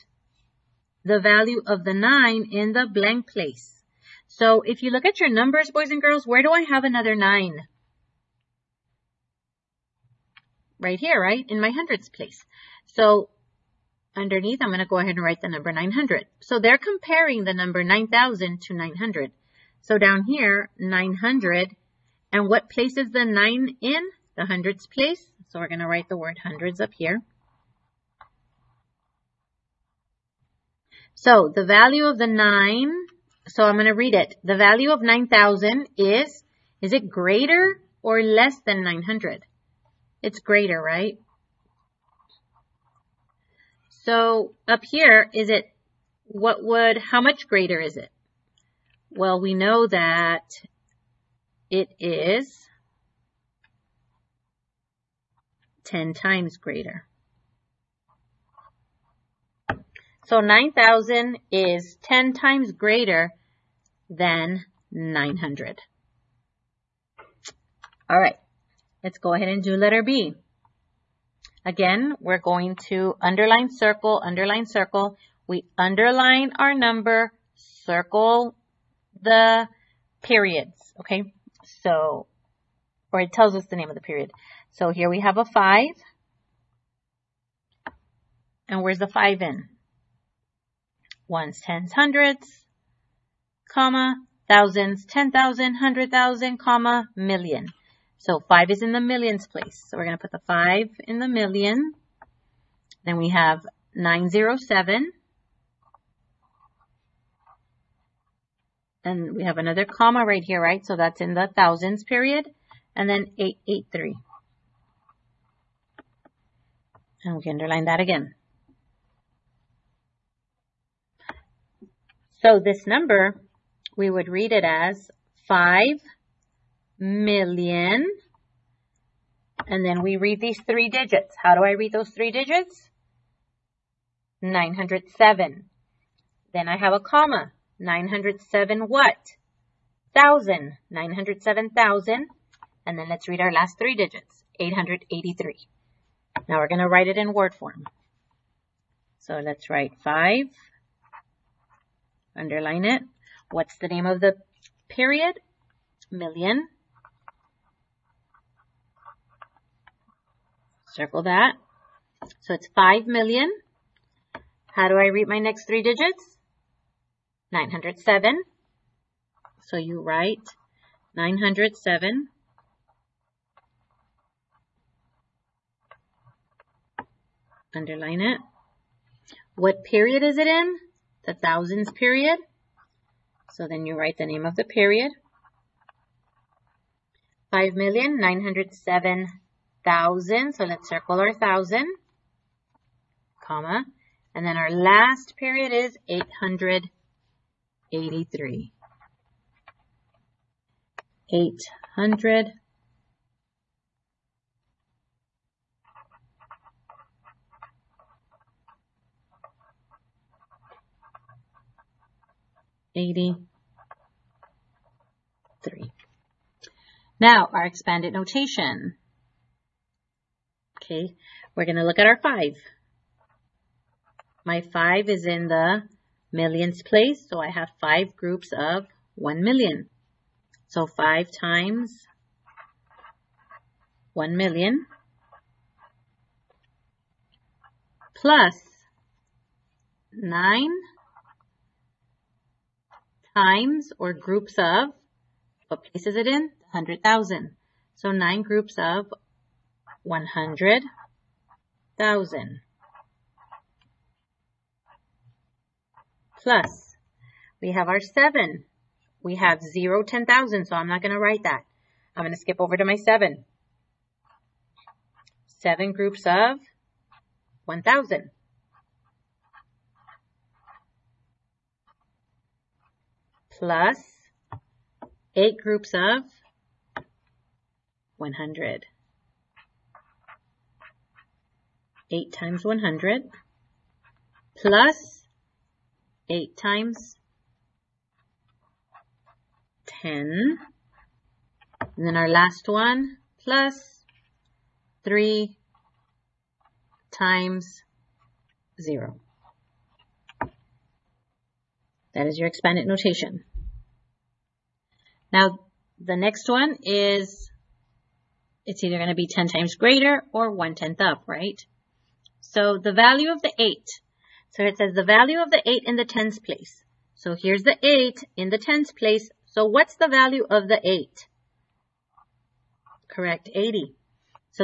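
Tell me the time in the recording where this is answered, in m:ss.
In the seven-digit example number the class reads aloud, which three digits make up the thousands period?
1:43.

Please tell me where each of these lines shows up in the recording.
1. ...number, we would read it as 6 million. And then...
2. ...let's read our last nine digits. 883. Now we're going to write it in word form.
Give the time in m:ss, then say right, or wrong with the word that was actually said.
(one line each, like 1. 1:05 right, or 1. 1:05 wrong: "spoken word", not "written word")
1. 2:02 wrong: "5", not "6"
2. 2:23 wrong: "three", not "nine".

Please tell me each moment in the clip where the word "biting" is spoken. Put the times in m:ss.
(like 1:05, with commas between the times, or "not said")
not said.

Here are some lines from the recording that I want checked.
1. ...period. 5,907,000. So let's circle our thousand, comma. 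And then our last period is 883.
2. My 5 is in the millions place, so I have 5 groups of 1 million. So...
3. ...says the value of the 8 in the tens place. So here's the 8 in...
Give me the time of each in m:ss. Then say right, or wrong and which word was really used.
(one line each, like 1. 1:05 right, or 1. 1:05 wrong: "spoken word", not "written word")
1. 3:04 right
2. 3:44 right
3. 5:14 right.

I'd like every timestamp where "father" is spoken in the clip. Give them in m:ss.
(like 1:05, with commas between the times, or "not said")
not said.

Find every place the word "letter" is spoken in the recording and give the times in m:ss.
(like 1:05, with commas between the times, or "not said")
1:09.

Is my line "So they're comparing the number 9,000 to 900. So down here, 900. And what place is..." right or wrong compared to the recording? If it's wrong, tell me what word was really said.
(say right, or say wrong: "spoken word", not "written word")
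right.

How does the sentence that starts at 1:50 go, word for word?
So that's in the thousands period.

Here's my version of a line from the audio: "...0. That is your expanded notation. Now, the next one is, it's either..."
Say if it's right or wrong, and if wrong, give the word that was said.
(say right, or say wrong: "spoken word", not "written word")
right.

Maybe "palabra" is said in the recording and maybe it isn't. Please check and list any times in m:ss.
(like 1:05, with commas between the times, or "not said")
not said.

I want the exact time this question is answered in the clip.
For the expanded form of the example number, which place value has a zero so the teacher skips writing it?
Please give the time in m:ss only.
4:20.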